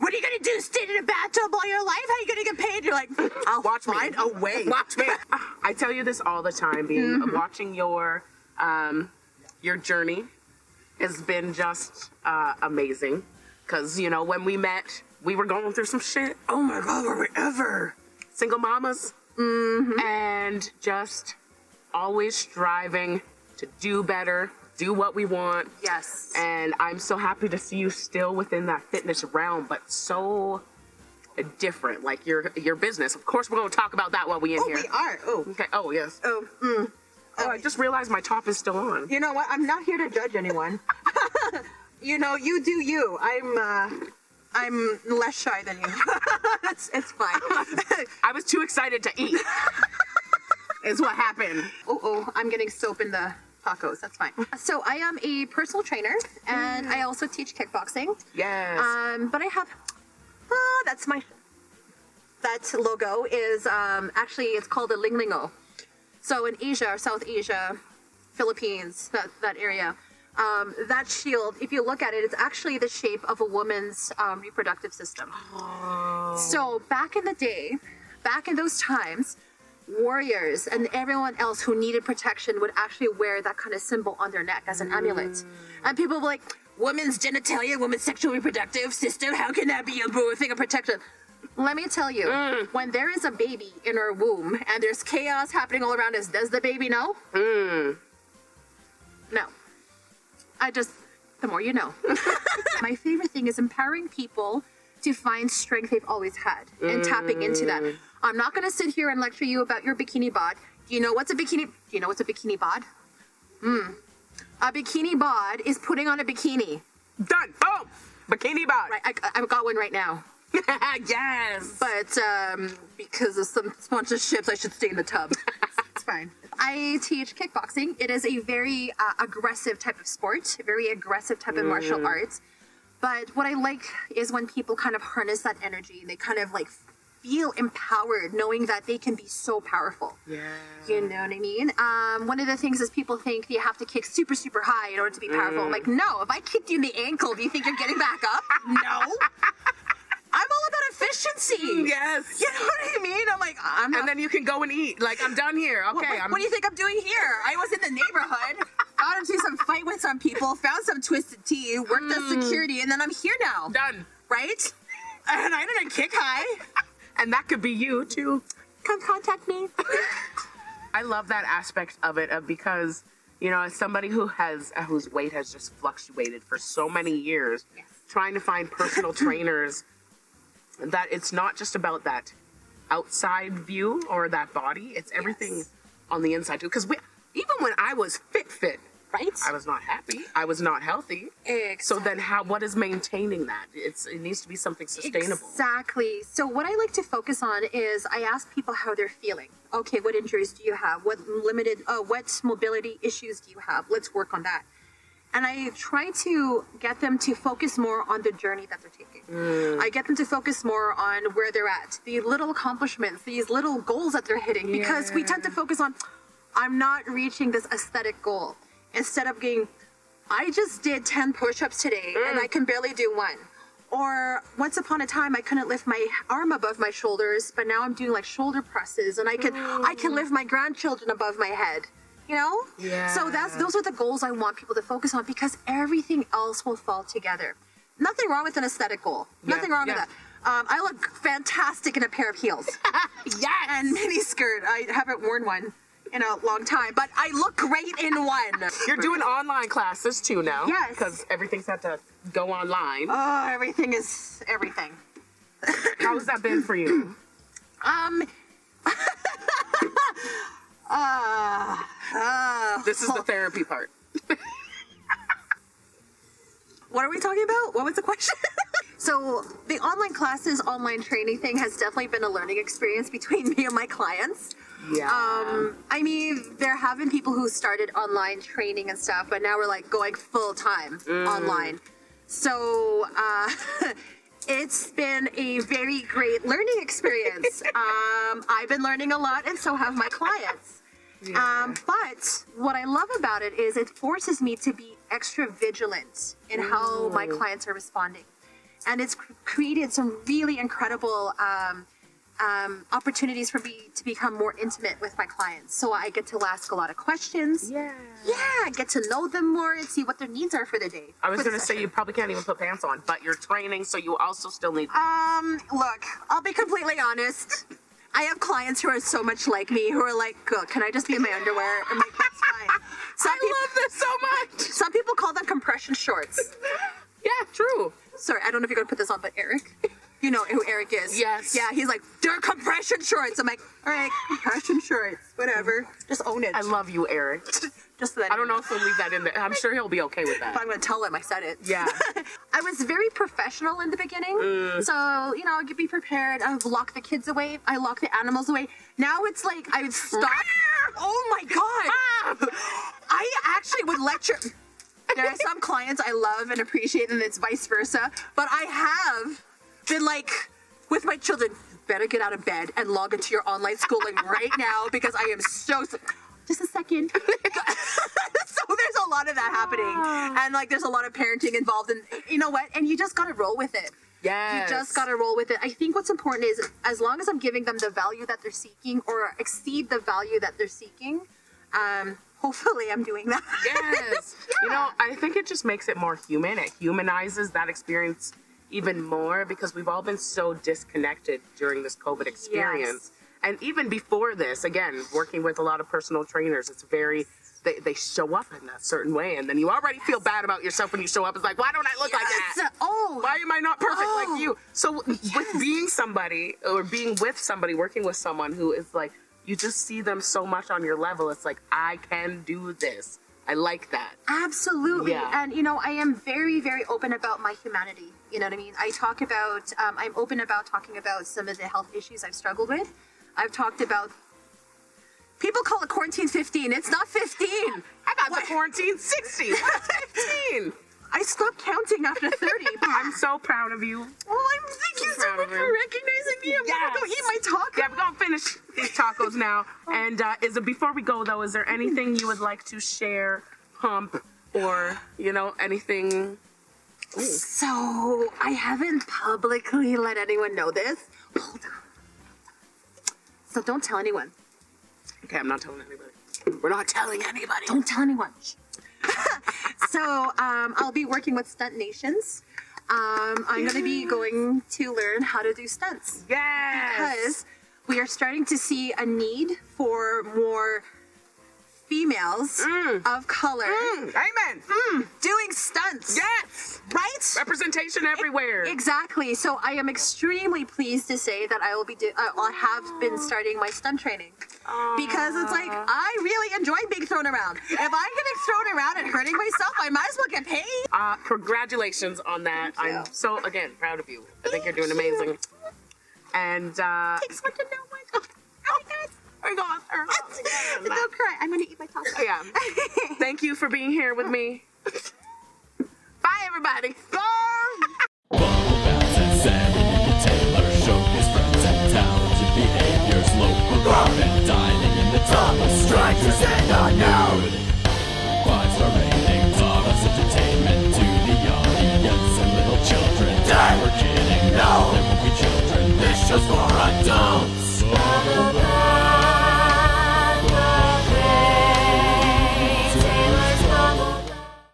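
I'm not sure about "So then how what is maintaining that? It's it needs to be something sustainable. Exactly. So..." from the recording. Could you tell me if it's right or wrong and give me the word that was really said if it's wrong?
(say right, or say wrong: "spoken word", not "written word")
right.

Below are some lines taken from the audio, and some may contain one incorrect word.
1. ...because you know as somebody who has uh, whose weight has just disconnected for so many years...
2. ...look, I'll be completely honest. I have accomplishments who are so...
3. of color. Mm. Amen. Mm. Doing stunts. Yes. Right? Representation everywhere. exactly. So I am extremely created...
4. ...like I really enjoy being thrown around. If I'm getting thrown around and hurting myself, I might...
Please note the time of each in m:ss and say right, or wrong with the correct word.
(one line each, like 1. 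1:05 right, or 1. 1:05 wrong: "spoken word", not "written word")
1. 2:52 wrong: "fluctuated", not "disconnected"
2. 5:15 wrong: "clients", not "accomplishments"
3. 7:53 wrong: "pleased", not "created"
4. 8:05 right.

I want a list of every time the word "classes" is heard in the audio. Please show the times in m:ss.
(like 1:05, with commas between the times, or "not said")
4:09, 4:30.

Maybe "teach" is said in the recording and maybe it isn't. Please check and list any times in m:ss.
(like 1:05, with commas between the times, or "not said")
0:57, 2:07.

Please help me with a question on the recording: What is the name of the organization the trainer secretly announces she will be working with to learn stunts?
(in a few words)
Stunt Nations.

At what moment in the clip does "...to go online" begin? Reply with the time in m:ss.
4:11.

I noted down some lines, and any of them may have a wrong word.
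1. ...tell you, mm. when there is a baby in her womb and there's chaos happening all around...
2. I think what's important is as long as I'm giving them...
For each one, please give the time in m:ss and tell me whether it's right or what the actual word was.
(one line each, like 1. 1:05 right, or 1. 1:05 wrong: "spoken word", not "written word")
1. 1:31 right
2. 6:15 right.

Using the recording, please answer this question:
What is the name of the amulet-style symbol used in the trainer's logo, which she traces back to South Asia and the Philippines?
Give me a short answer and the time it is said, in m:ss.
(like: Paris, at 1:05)
lingling-o, at 1:04.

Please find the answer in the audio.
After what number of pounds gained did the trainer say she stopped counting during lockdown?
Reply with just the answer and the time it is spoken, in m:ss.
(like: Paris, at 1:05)
30, at 7:12.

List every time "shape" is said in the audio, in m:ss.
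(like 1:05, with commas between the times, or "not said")
1:12.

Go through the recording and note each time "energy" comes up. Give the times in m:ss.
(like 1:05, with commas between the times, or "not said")
2:15.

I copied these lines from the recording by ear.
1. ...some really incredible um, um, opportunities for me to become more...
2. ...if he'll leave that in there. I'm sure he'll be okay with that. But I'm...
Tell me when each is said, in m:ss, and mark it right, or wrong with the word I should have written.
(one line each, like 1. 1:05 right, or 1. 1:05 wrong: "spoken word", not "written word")
1. 4:59 right
2. 5:38 right.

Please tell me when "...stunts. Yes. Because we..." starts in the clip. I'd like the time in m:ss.
7:45.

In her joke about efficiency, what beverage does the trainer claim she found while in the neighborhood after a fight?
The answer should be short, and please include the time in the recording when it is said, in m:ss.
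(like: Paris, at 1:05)
twisted tea, at 2:41.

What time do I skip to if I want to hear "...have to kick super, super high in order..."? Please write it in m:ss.
2:23.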